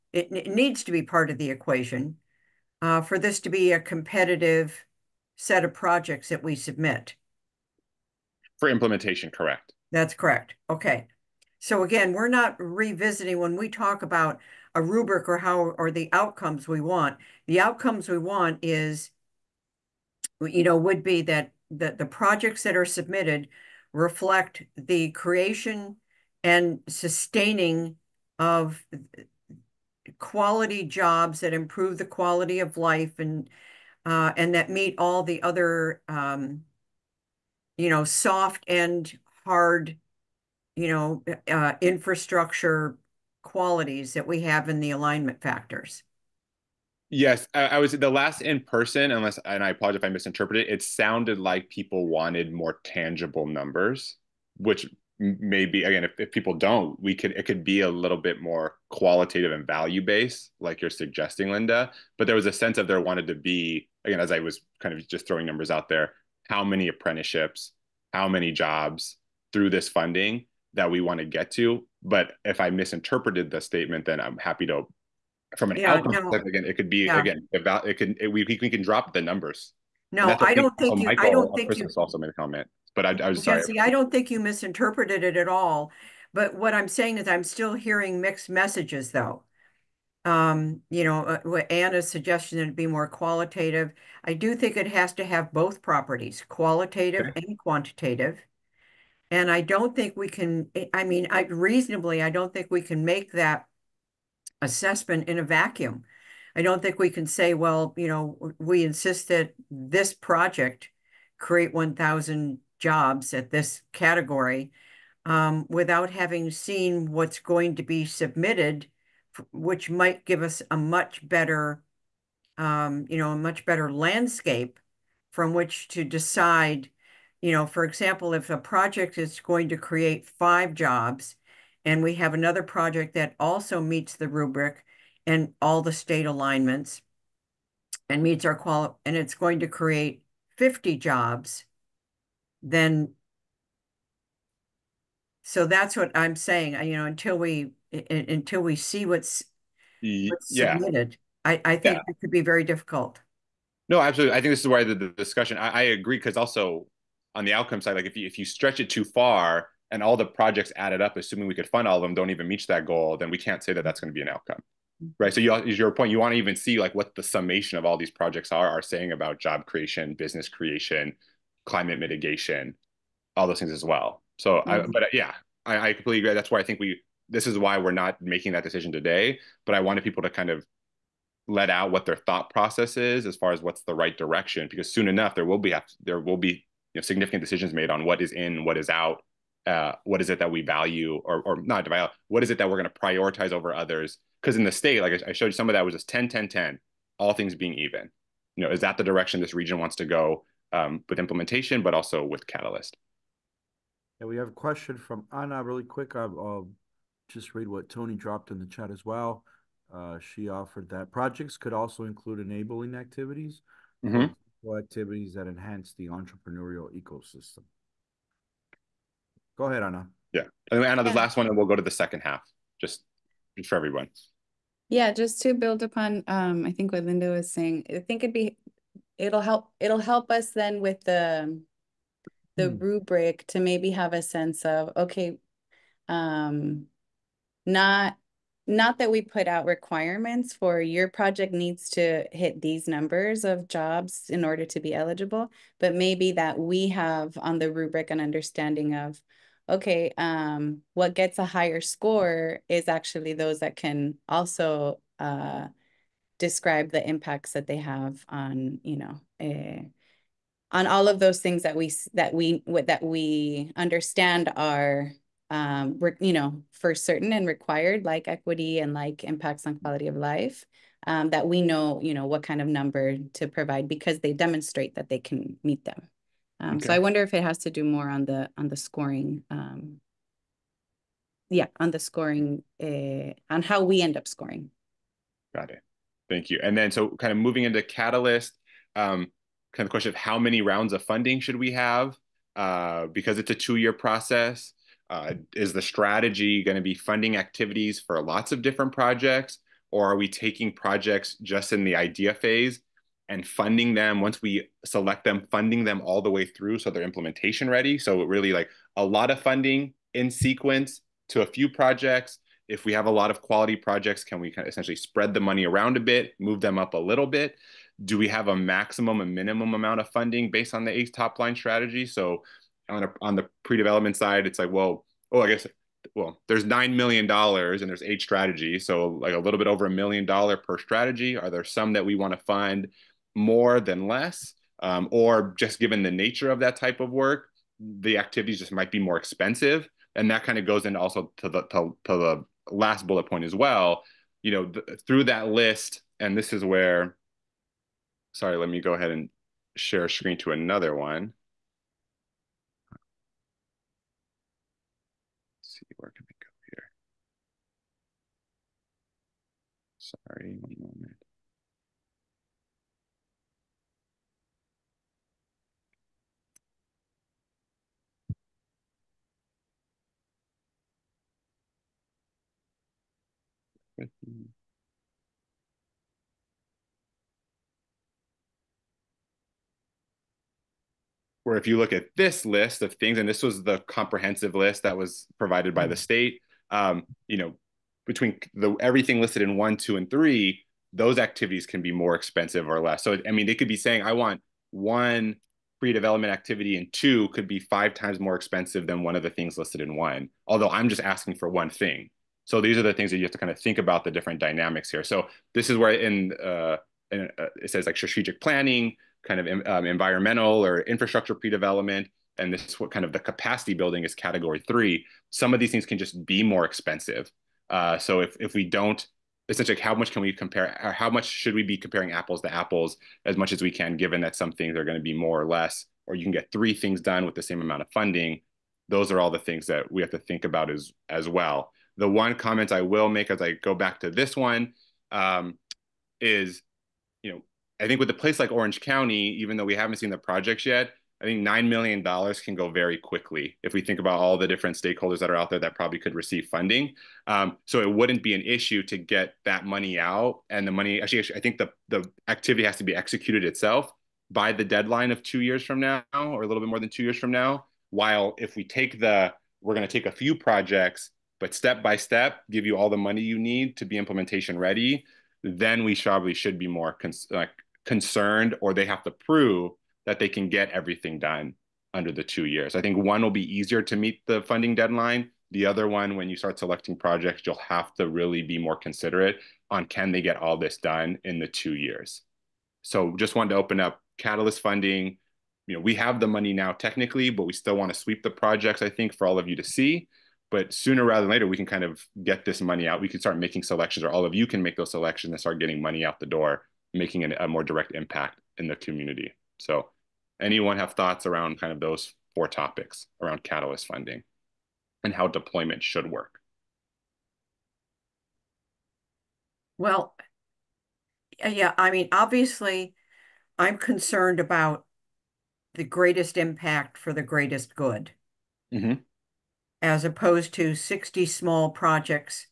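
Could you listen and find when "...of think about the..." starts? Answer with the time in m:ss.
6:43.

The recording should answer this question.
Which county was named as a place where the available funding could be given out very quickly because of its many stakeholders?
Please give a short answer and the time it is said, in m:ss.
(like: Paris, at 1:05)
Orange County, at 7:18.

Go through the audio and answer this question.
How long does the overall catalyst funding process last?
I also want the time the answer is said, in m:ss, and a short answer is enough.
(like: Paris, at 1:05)
2 years, at 4:53.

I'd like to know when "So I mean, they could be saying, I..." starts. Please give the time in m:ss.
6:33.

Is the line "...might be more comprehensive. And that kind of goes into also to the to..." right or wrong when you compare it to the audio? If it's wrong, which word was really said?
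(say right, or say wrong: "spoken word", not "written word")
wrong: "expensive", not "comprehensive".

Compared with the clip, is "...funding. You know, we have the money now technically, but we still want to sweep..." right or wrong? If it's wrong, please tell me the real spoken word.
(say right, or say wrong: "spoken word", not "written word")
right.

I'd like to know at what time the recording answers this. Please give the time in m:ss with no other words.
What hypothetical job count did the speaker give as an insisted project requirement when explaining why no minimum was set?
1:51.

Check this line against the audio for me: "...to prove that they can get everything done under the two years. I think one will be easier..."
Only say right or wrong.
right.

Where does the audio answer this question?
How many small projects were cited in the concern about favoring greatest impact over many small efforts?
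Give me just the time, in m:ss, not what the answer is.
8:40.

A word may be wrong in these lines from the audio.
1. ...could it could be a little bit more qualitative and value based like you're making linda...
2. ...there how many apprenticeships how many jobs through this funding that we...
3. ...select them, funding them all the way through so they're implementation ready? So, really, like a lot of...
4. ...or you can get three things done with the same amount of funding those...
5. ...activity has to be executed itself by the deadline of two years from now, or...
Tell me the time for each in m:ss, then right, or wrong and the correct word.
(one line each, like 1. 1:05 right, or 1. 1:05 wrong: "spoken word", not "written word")
1. 0:57 wrong: "suggesting", not "making"
2. 1:05 right
3. 5:04 right
4. 7:06 right
5. 7:32 right.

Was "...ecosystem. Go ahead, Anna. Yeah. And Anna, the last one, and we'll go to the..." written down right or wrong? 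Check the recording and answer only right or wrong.
right.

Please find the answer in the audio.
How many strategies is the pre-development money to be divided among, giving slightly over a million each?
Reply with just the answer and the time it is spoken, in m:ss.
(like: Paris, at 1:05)
8, at 5:28.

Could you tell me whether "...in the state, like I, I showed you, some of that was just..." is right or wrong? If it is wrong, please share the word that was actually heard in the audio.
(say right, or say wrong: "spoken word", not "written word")
right.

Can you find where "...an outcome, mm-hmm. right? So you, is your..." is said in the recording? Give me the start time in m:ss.
2:44.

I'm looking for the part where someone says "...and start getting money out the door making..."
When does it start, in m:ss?
8:15.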